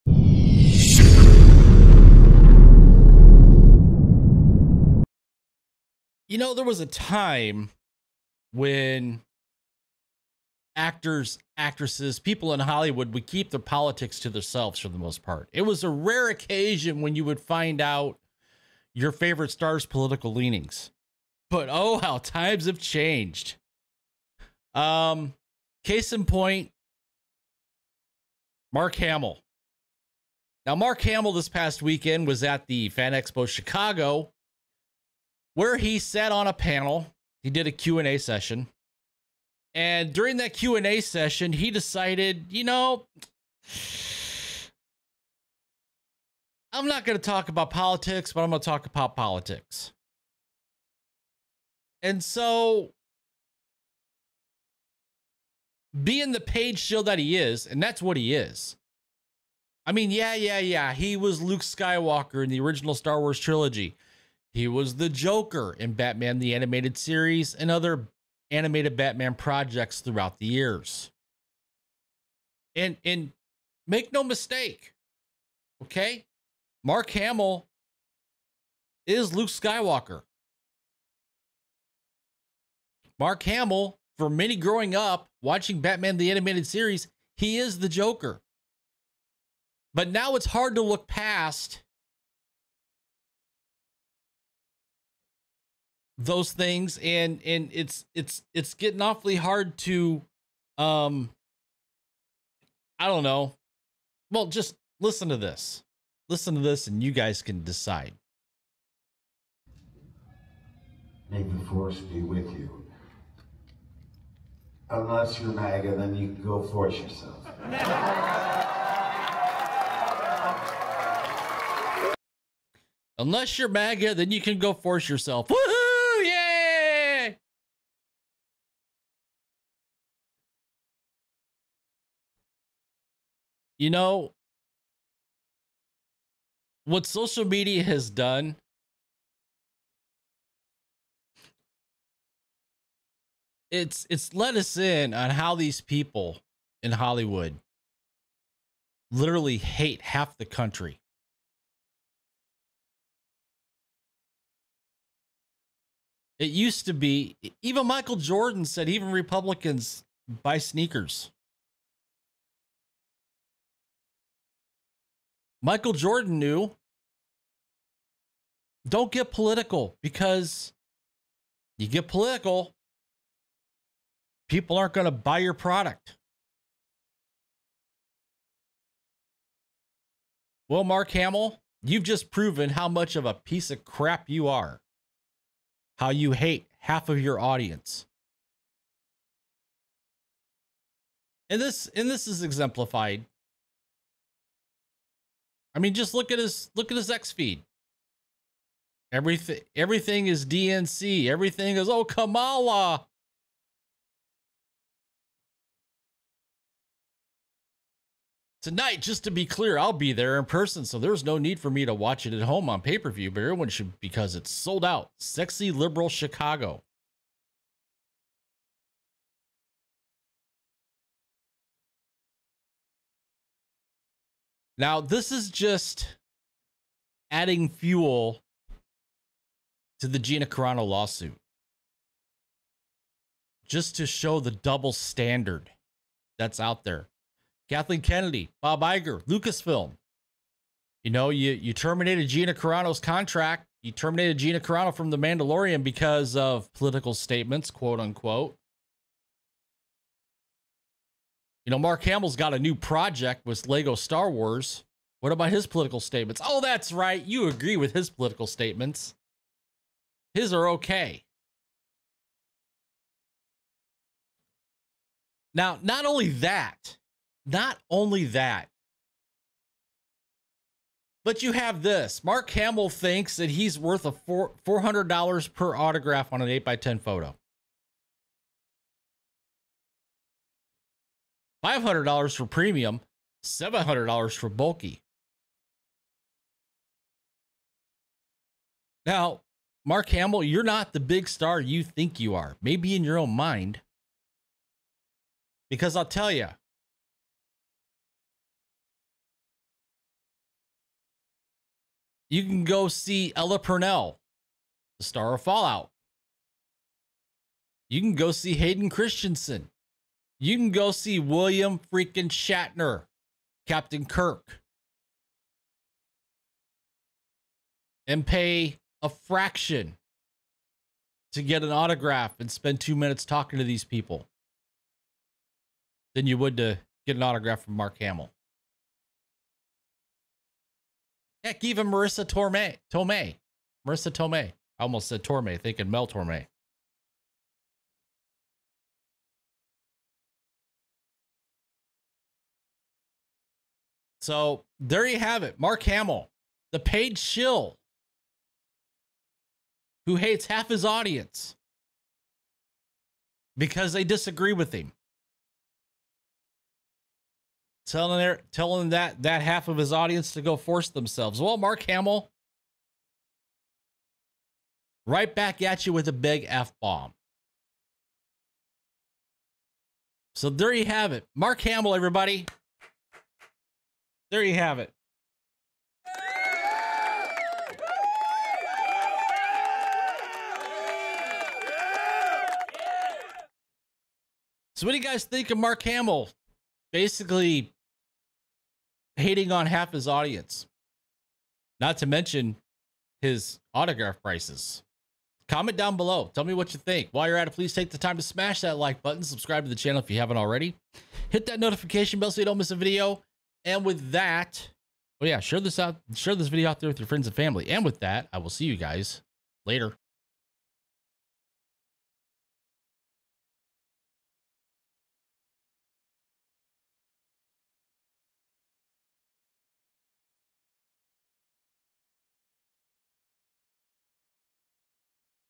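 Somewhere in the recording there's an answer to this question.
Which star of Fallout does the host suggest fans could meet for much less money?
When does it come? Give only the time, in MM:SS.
05:03.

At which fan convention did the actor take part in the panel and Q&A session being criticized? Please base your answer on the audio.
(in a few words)
Fan Expo Chicago.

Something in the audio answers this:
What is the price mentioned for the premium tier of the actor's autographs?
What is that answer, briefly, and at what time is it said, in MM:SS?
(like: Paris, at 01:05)
$500, at 04:41.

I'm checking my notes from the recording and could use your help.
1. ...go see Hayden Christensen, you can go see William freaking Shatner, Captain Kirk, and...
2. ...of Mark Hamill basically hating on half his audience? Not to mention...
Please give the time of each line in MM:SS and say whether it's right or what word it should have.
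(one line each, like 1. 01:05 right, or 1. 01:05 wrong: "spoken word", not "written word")
1. 05:08 right
2. 06:25 right.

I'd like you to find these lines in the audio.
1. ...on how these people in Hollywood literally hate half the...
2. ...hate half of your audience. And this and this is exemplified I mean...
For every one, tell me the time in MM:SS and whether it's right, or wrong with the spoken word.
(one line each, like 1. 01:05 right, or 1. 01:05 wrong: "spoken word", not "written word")
1. 02:25 right
2. 03:06 right.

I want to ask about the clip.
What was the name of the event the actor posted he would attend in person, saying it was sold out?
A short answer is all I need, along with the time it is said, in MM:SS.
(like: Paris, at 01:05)
Sexy Liberal Chicago, at 03:35.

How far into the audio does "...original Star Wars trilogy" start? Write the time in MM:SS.
01:02.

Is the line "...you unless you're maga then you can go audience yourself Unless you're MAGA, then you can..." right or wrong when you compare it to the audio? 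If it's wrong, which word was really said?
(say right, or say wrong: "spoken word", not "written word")
wrong: "force", not "audience".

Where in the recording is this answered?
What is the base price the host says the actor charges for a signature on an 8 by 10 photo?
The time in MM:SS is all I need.
04:34.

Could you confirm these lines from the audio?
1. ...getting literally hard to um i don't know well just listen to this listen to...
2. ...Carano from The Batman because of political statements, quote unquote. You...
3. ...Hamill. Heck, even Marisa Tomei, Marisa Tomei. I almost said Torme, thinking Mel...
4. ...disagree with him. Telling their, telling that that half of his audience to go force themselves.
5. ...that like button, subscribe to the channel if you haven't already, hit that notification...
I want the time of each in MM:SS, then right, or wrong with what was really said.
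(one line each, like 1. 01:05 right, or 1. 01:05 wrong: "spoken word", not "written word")
1. 01:38 wrong: "awfully", not "literally"
2. 04:04 wrong: "Mandalorian", not "Batman"
3. 05:28 right
4. 05:54 right
5. 06:38 right.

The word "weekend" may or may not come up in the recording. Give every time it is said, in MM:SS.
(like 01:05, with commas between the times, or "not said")
00:31.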